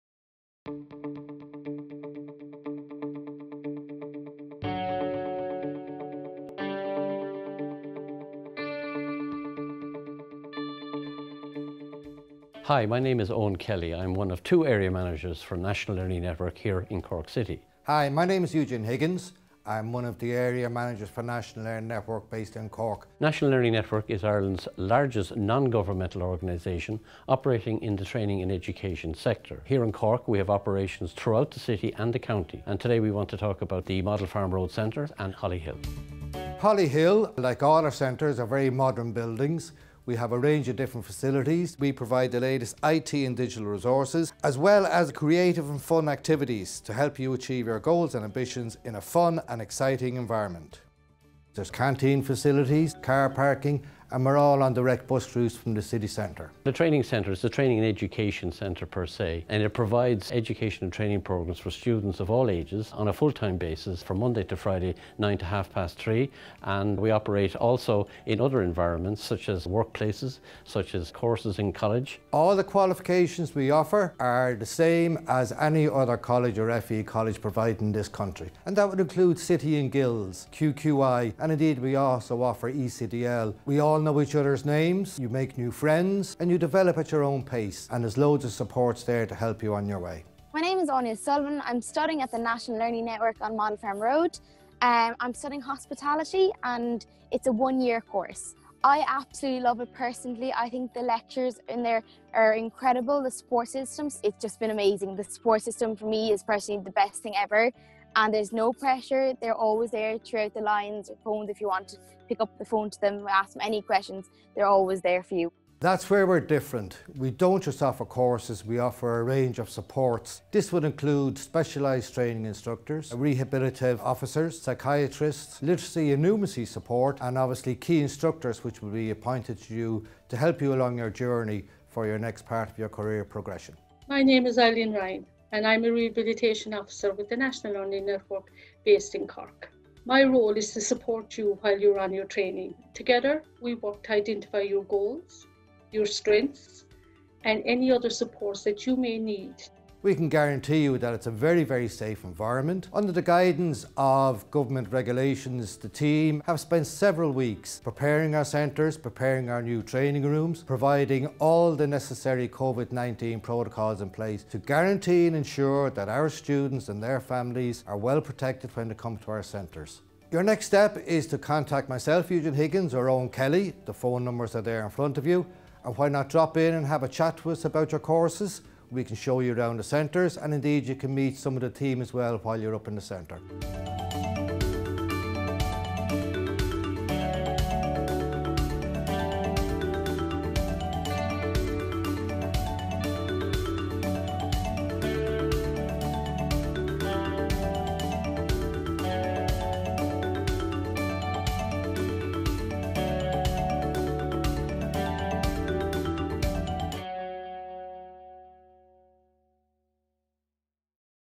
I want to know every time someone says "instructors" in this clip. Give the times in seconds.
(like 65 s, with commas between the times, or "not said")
122 s, 128 s.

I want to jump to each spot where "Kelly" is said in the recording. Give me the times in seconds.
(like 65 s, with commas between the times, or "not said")
13 s, 173 s.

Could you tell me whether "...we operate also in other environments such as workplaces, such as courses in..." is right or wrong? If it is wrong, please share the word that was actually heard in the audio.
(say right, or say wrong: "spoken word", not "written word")
right.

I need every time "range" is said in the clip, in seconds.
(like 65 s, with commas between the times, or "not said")
40 s, 119 s.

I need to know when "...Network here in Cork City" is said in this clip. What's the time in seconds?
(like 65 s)
16 s.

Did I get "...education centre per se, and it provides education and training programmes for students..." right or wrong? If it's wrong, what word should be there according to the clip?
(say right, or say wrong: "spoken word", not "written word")
right.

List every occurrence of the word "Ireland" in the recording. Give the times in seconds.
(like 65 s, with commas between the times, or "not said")
24 s.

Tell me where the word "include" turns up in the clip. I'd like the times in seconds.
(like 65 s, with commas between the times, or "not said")
78 s, 120 s.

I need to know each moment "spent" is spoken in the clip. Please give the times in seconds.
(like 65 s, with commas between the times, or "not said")
156 s.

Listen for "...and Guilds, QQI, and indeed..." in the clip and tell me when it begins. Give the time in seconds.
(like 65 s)
79 s.